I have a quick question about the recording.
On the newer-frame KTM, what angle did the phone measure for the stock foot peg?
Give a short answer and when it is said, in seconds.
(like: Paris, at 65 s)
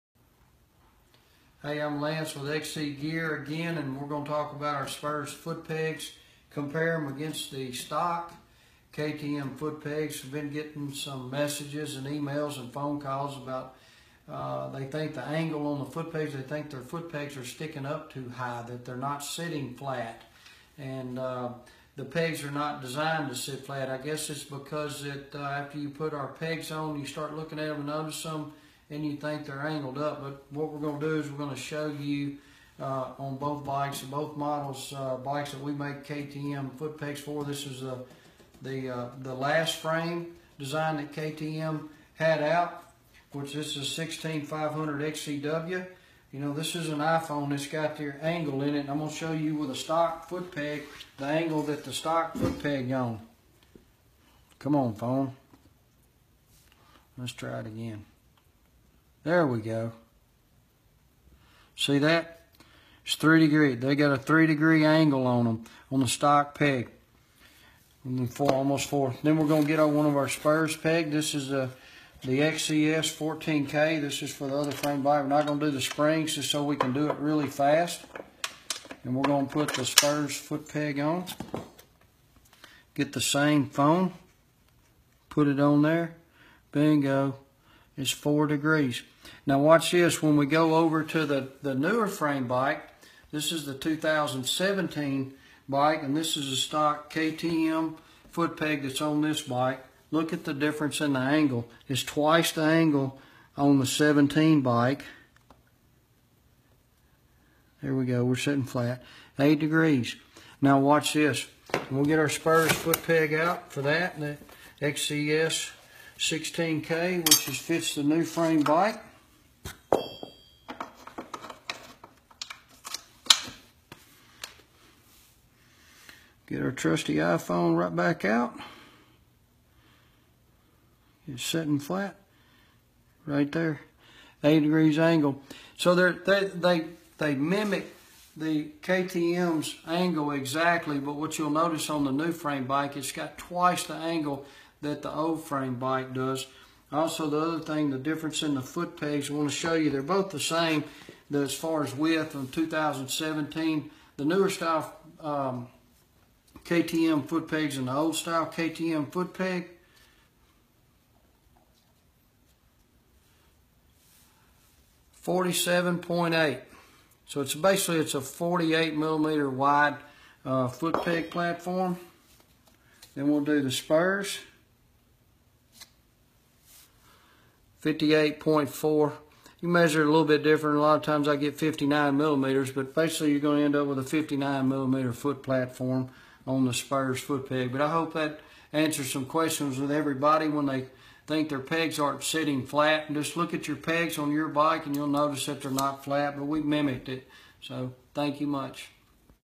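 8 degrees, at 109 s.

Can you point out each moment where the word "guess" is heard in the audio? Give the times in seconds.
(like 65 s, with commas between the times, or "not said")
23 s.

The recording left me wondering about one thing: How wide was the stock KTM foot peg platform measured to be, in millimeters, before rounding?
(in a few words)
47.8.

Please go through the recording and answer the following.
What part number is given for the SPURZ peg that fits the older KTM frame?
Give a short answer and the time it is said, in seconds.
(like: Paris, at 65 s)
XCS 14K, at 72 s.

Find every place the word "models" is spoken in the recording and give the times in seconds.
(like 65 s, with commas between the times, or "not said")
34 s.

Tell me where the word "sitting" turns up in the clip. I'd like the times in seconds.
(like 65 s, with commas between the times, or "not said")
19 s, 108 s, 131 s, 192 s.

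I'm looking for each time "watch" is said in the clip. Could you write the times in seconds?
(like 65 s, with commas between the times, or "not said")
89 s, 110 s.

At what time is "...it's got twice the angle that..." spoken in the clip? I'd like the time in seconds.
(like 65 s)
142 s.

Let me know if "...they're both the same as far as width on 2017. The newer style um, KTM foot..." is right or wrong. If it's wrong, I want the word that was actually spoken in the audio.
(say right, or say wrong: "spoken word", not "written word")
right.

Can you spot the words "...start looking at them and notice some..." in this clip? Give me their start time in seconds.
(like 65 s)
27 s.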